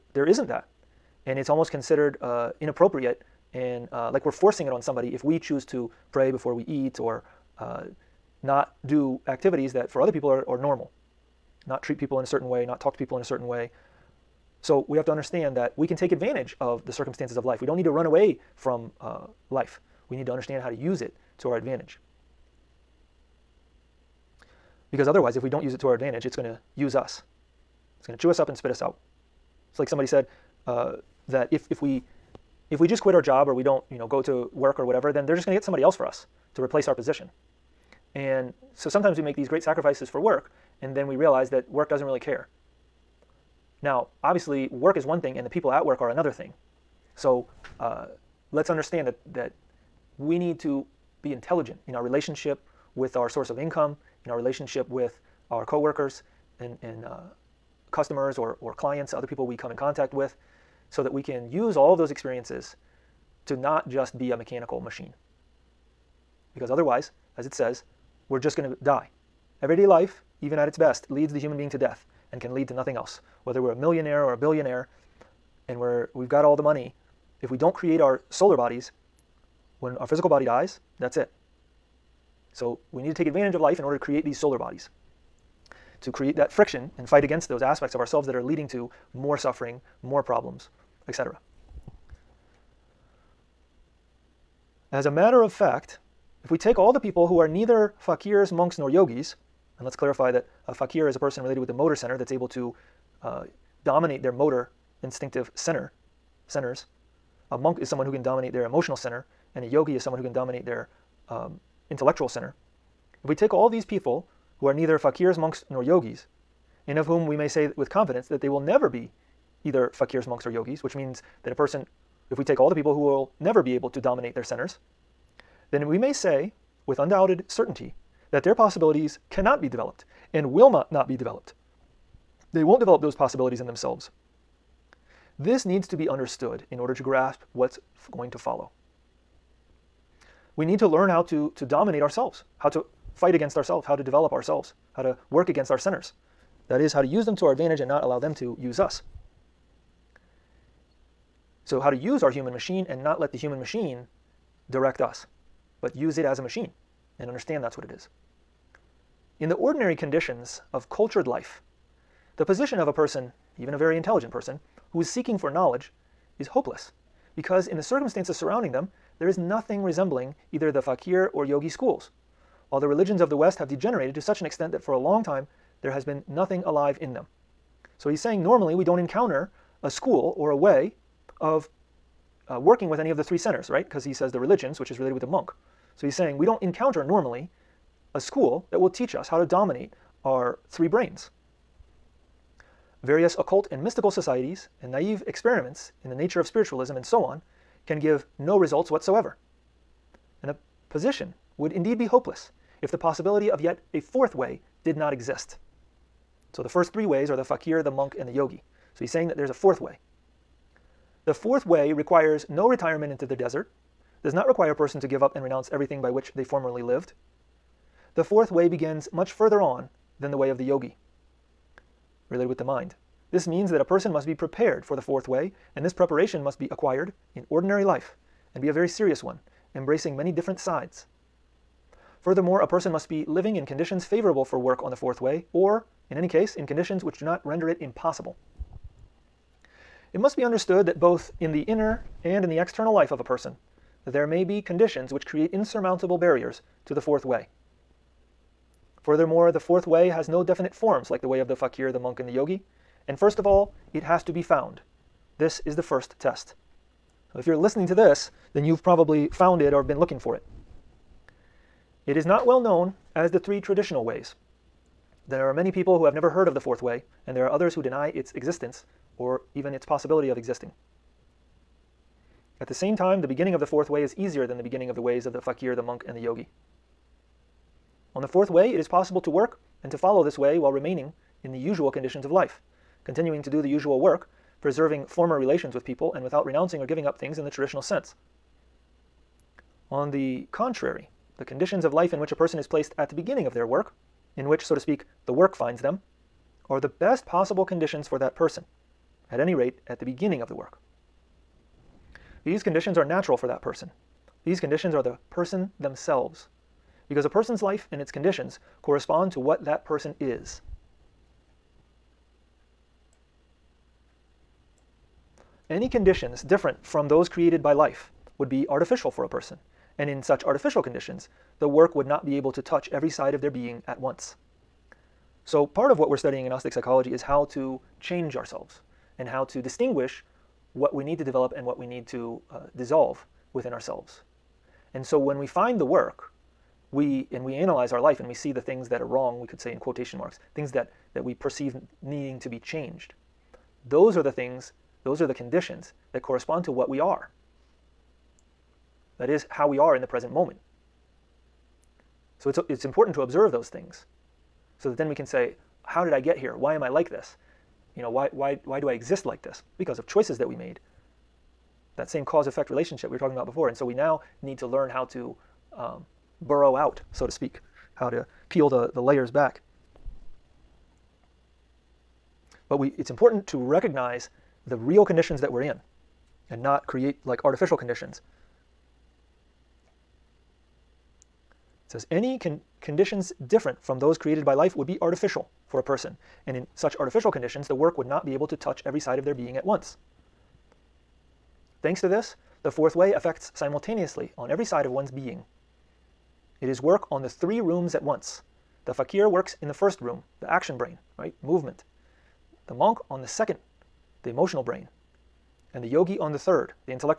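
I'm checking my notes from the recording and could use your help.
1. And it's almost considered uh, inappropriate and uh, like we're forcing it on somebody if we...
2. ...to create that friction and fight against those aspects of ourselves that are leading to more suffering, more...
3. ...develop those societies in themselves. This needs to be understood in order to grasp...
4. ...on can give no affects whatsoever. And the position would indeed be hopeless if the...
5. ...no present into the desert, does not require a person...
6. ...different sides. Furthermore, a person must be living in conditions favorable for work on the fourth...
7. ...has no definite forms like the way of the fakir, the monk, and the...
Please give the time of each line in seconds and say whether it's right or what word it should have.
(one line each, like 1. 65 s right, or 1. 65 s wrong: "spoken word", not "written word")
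1. 1 s right
2. 86 s right
3. 132 s wrong: "possibilities", not "societies"
4. 197 s wrong: "results", not "affects"
5. 212 s wrong: "retirement", not "present"
6. 230 s right
7. 250 s right.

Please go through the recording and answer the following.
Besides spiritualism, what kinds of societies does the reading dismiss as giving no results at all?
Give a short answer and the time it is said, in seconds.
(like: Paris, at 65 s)
occult and mystical societies, at 193 s.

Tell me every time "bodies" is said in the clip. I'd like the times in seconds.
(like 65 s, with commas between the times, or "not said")
78 s, 84 s.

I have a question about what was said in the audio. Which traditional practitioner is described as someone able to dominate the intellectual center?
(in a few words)
a yogi.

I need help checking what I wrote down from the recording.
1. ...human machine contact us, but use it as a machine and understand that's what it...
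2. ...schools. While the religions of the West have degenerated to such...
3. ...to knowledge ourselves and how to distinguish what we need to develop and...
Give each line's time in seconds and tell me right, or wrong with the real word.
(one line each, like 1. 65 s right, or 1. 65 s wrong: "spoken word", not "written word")
1. 153 s wrong: "direct", not "contact"
2. 171 s right
3. 327 s wrong: "change", not "knowledge".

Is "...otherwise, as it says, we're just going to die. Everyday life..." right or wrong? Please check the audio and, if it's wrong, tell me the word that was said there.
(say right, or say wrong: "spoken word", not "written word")
right.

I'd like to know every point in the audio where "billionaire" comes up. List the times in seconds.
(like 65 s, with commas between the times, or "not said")
74 s.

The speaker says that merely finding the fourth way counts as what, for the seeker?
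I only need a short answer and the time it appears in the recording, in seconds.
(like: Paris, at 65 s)
the first test, at 255 s.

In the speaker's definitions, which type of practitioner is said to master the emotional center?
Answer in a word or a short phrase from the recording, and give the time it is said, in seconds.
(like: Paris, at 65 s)
a monk, at 107 s.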